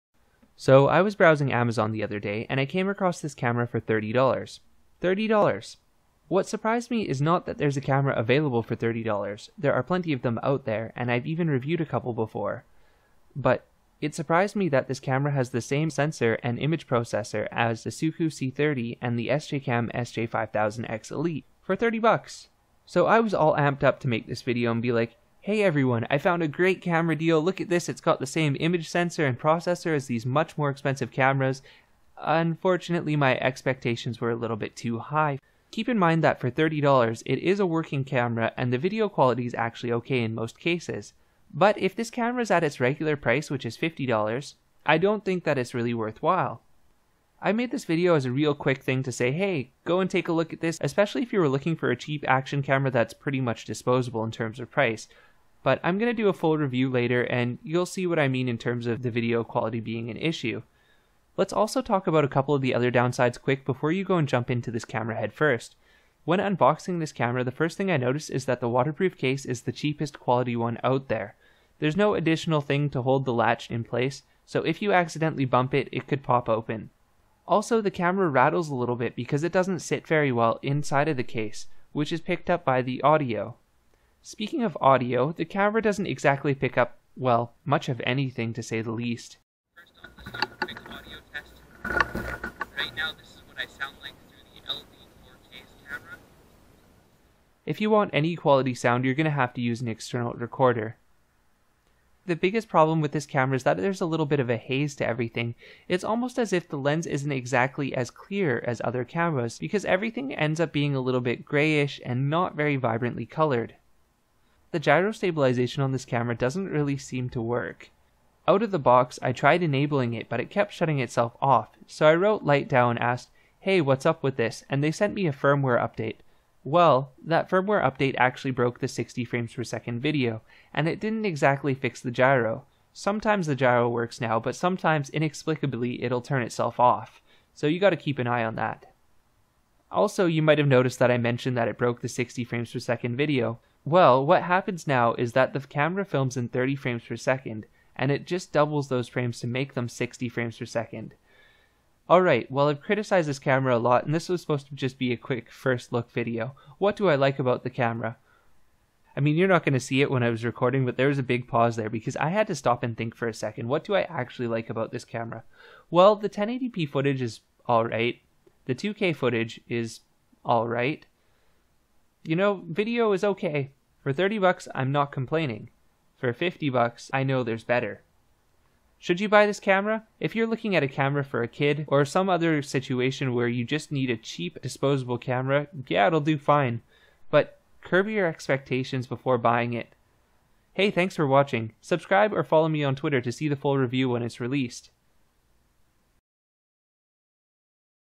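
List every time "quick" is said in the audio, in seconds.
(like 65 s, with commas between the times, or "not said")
48 s, 63 s, 155 s.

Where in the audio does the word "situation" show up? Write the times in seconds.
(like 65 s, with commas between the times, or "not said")
182 s.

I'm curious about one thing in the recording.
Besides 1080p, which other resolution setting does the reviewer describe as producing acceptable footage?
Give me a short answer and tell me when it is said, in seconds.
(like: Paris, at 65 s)
2K, at 168 s.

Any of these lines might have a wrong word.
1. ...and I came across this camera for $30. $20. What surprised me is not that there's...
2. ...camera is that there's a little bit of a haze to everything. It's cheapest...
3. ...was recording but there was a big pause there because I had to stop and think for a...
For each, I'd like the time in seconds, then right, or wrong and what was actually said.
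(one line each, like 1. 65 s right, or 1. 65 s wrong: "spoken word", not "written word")
1. 2 s wrong: "30", not "20"
2. 103 s wrong: "almost", not "cheapest"
3. 160 s right.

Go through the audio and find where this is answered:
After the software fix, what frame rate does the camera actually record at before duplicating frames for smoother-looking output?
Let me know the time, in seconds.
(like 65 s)
146 s.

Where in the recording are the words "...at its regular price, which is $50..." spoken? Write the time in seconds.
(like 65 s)
42 s.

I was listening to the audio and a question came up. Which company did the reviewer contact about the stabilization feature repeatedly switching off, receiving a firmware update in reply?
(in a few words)
LightDow.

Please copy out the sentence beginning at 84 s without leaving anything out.
Speaking of audio, the camera doesn't exactly pick up, well, much of anything to say the least.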